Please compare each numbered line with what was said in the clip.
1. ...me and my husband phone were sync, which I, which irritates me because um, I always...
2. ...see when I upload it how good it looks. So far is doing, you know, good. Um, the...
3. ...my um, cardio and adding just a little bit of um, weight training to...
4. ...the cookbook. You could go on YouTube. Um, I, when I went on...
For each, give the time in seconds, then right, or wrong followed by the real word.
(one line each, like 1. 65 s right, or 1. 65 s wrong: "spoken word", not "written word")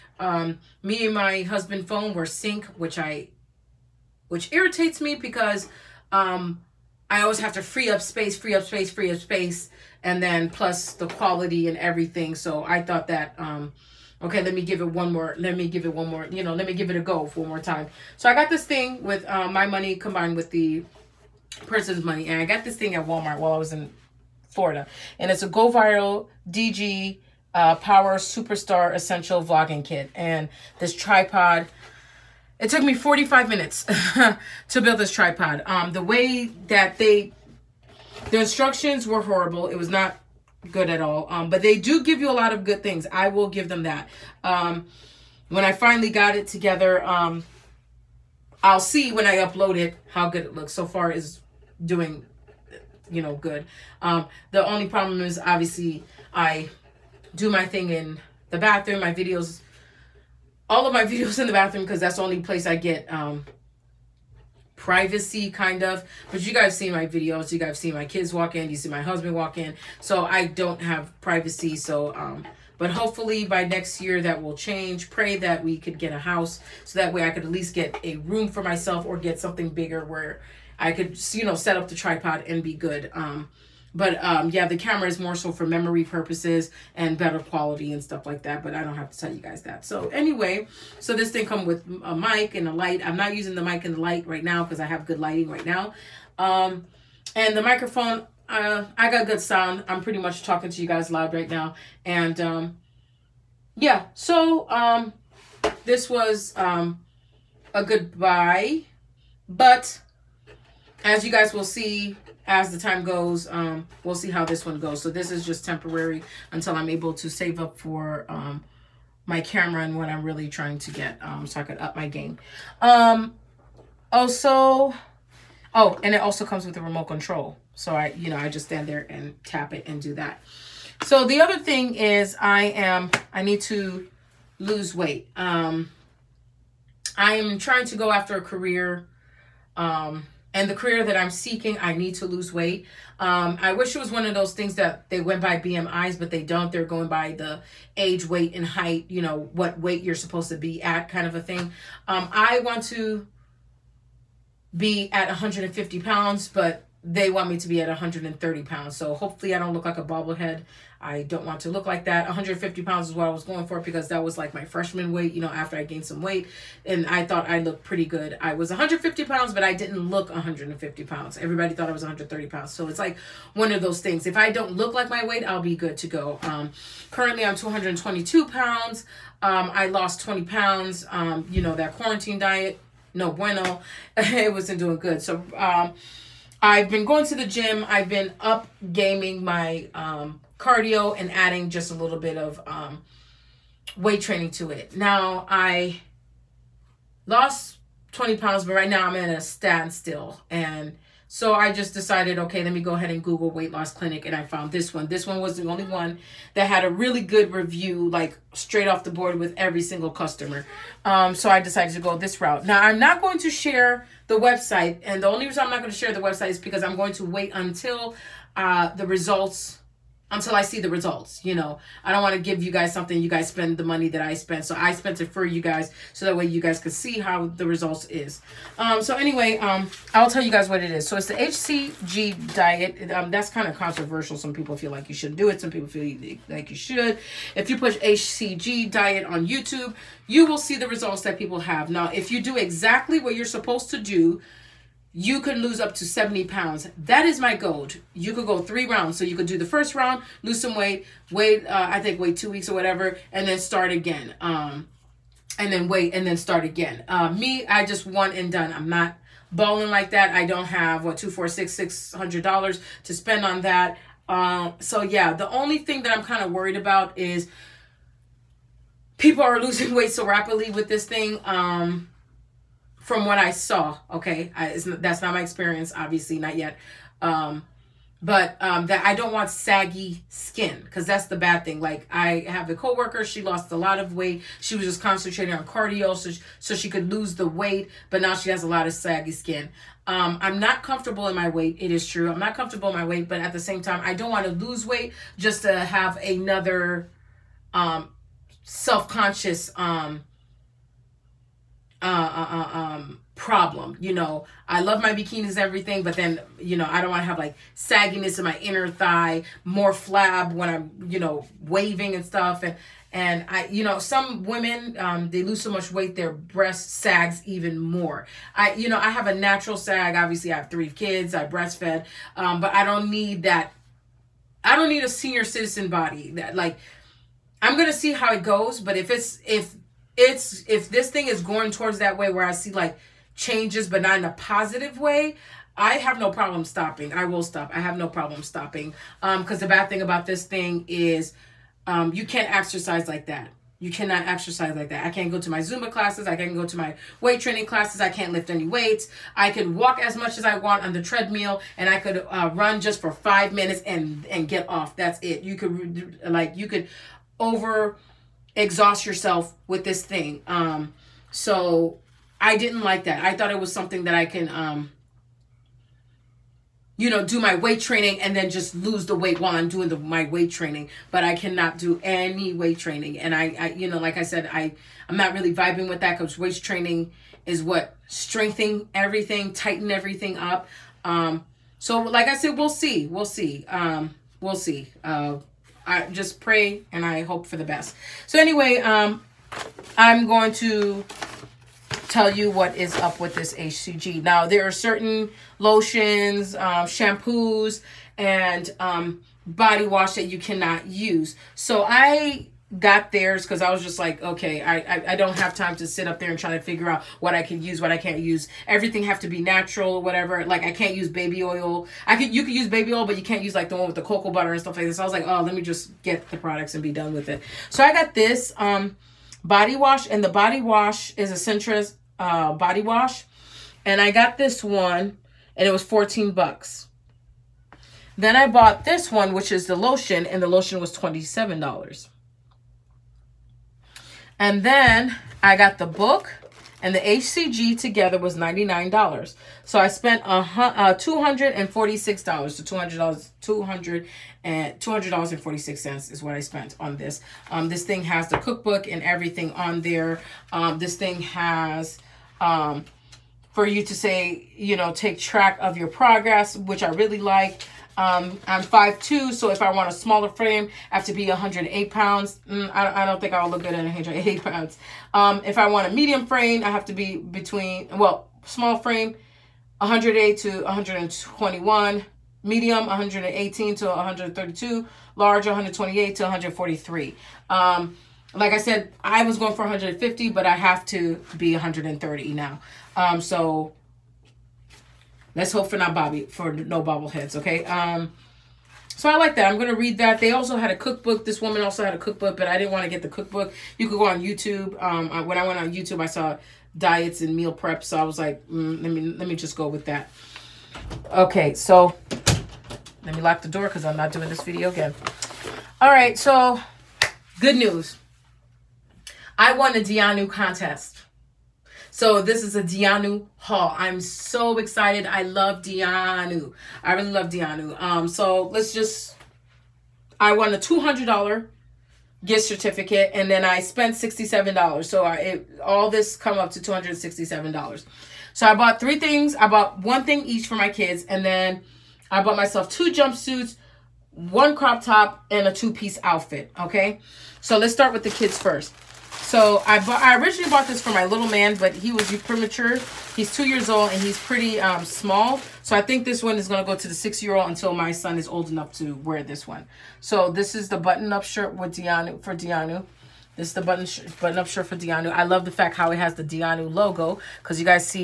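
1. 0 s right
2. 48 s right
3. 189 s right
4. 493 s right.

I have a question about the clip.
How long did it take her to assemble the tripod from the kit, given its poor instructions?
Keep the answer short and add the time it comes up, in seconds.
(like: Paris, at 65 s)
45 minutes, at 32 s.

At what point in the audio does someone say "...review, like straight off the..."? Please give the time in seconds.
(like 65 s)
207 s.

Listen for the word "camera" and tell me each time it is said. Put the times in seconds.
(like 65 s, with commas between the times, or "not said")
84 s, 119 s.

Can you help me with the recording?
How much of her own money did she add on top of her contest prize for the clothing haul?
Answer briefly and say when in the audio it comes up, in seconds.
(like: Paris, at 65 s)
$67, at 523 s.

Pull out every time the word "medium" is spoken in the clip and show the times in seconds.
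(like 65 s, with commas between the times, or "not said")
465 s, 472 s.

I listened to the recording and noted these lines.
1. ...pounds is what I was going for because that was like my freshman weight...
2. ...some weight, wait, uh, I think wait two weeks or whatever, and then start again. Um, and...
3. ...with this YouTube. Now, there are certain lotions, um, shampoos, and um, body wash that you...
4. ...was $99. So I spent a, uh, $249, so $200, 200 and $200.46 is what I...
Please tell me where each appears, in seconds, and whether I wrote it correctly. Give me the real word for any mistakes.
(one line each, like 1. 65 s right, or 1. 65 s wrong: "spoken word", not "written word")
1. 162 s right
2. 250 s right
3. 393 s wrong: "HCG", not "YouTube"
4. 438 s wrong: "246", not "249".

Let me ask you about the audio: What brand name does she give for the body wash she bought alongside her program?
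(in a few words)
Centris.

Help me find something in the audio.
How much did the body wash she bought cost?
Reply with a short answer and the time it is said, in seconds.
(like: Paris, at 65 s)
$14, at 425 s.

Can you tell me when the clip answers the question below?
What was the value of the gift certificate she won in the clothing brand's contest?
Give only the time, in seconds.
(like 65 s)
520 s.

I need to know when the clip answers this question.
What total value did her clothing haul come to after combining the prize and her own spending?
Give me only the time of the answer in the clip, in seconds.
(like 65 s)
526 s.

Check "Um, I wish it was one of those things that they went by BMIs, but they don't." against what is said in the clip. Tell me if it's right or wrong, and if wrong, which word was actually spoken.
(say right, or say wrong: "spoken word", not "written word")
right.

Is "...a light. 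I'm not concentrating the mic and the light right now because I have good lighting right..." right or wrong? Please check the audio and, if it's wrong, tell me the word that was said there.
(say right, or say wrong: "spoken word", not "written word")
wrong: "using", not "concentrating".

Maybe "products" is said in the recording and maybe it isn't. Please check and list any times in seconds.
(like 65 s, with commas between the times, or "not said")
416 s.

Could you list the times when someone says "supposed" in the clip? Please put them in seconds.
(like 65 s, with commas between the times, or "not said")
150 s, 243 s.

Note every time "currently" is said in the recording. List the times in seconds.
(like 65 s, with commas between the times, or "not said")
177 s.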